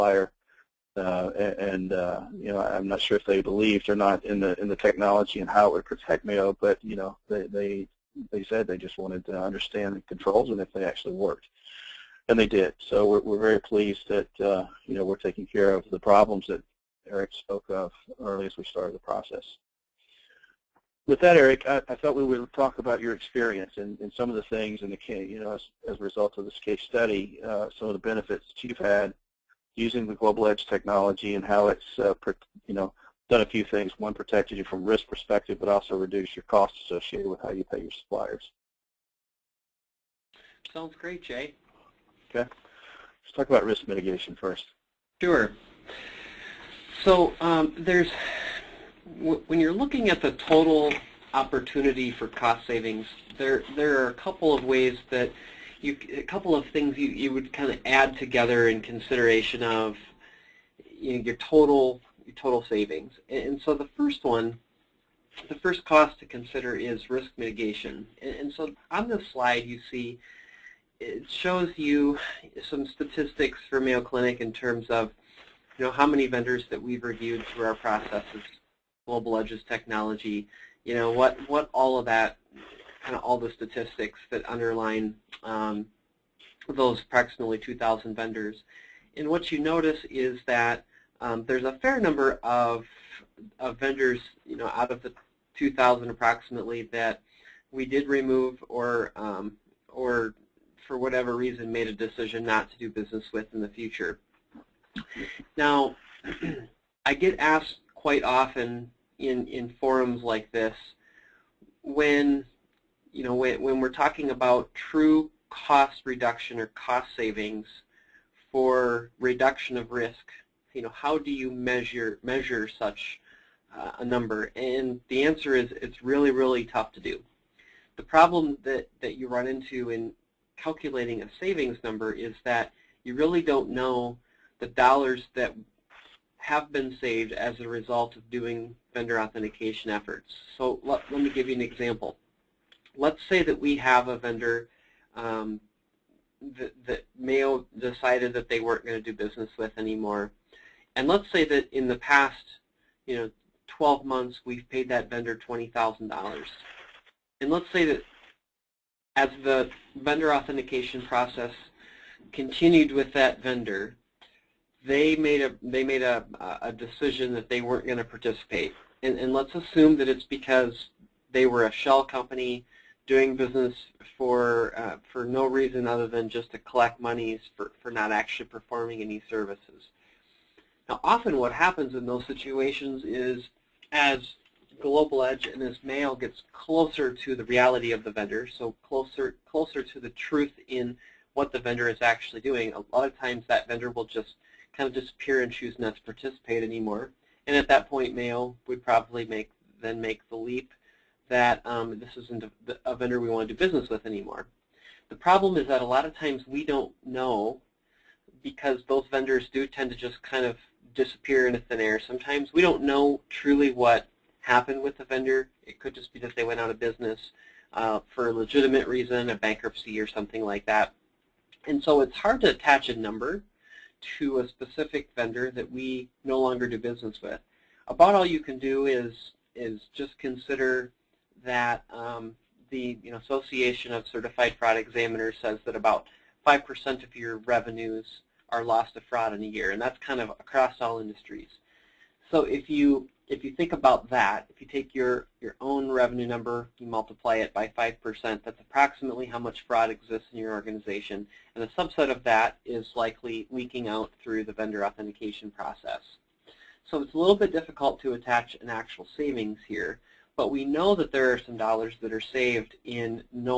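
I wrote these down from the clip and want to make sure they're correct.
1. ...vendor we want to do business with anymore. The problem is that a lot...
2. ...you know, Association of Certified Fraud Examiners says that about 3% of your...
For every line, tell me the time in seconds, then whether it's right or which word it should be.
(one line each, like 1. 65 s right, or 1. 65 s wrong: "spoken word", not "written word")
1. 202 s right
2. 233 s wrong: "5", not "3".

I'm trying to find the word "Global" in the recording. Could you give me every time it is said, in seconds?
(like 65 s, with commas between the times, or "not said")
30 s, 79 s, 184 s.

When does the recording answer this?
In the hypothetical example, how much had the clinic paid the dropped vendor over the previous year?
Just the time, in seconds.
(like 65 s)
155 s.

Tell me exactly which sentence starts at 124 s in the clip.
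And the answer is it's really, really tough to do.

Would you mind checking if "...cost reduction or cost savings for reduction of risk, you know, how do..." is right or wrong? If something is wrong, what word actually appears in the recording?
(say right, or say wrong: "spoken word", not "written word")
right.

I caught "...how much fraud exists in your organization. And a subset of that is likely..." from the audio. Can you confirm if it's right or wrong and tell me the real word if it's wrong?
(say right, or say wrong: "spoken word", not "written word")
right.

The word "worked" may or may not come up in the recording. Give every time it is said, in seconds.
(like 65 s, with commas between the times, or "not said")
11 s.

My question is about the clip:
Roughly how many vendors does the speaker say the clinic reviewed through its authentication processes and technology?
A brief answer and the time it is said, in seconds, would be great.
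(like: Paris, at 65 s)
2,000, at 87 s.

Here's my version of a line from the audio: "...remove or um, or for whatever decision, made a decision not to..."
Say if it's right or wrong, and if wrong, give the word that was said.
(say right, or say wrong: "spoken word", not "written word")
wrong: "reason", not "decision".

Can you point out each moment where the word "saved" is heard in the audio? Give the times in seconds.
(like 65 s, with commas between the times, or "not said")
137 s, 262 s.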